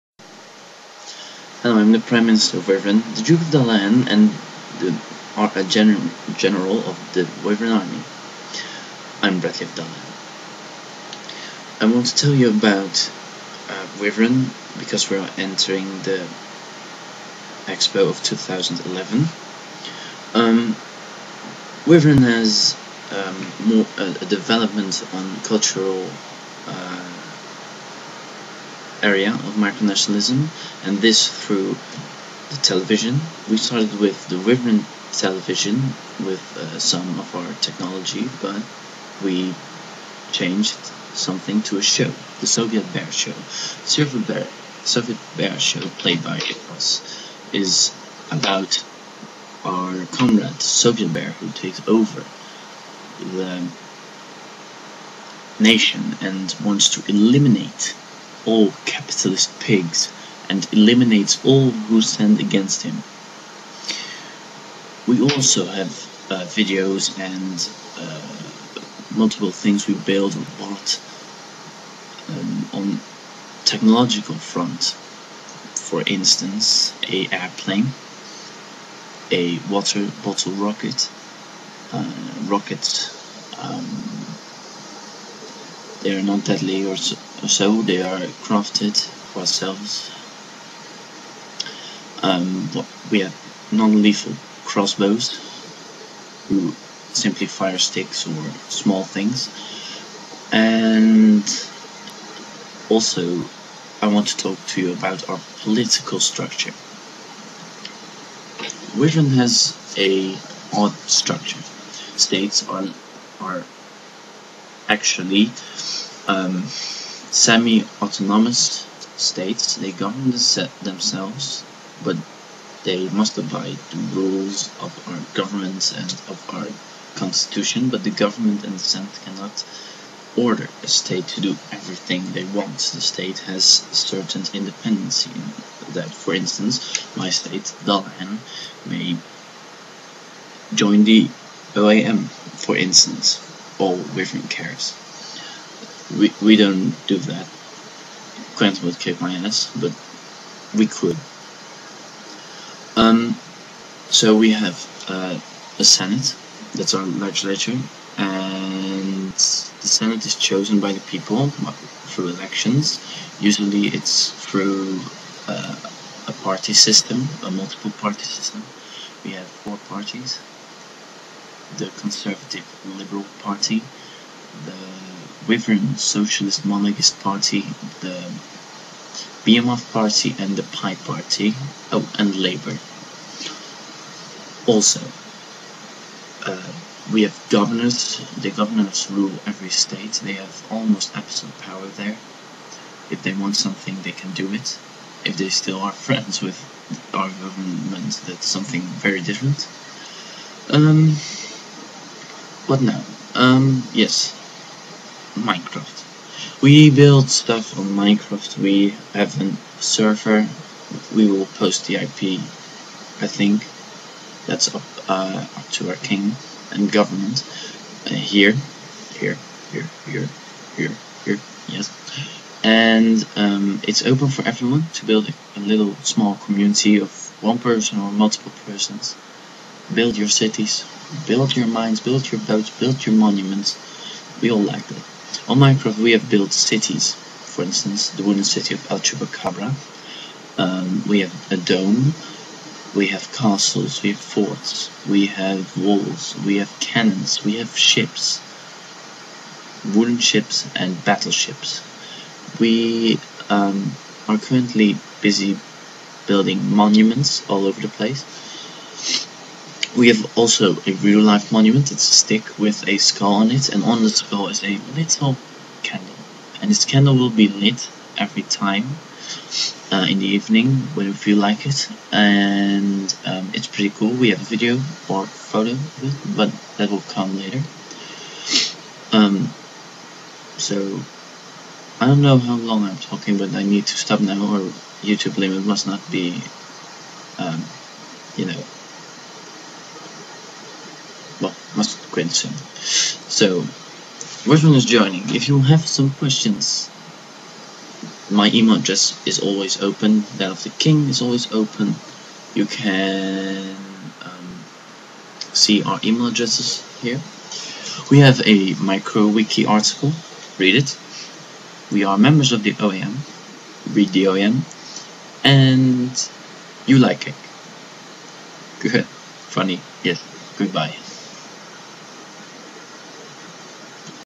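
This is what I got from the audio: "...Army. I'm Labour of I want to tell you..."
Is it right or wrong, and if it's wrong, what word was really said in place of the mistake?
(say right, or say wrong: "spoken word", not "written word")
wrong: "Bradley", not "Labour".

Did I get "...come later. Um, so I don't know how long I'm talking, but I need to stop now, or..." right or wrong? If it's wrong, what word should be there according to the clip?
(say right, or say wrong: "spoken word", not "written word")
right.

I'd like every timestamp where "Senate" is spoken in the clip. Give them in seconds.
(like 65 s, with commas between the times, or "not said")
128 s, 155 s, 159 s.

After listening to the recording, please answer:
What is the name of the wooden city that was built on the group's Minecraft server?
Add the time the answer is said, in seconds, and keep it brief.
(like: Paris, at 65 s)
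El Chupacabra, at 238 s.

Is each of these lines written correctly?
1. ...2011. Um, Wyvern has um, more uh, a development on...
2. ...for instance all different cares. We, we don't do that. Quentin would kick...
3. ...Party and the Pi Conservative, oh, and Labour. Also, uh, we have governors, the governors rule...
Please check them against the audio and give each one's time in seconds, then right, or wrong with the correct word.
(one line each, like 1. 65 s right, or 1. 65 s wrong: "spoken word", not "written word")
1. 18 s right
2. 142 s right
3. 179 s wrong: "Party", not "Conservative".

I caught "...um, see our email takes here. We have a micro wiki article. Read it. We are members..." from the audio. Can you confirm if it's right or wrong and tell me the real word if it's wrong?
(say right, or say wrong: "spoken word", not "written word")
wrong: "addresses", not "takes".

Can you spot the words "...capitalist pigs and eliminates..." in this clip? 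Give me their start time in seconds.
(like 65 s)
58 s.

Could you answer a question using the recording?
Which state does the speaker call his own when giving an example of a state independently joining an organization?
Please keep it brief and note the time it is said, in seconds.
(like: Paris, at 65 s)
Dullahan, at 137 s.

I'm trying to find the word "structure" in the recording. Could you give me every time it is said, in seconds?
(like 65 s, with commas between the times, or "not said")
106 s, 111 s.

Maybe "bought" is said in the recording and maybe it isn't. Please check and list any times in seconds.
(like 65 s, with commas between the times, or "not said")
70 s.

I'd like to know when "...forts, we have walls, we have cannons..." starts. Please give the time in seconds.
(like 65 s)
244 s.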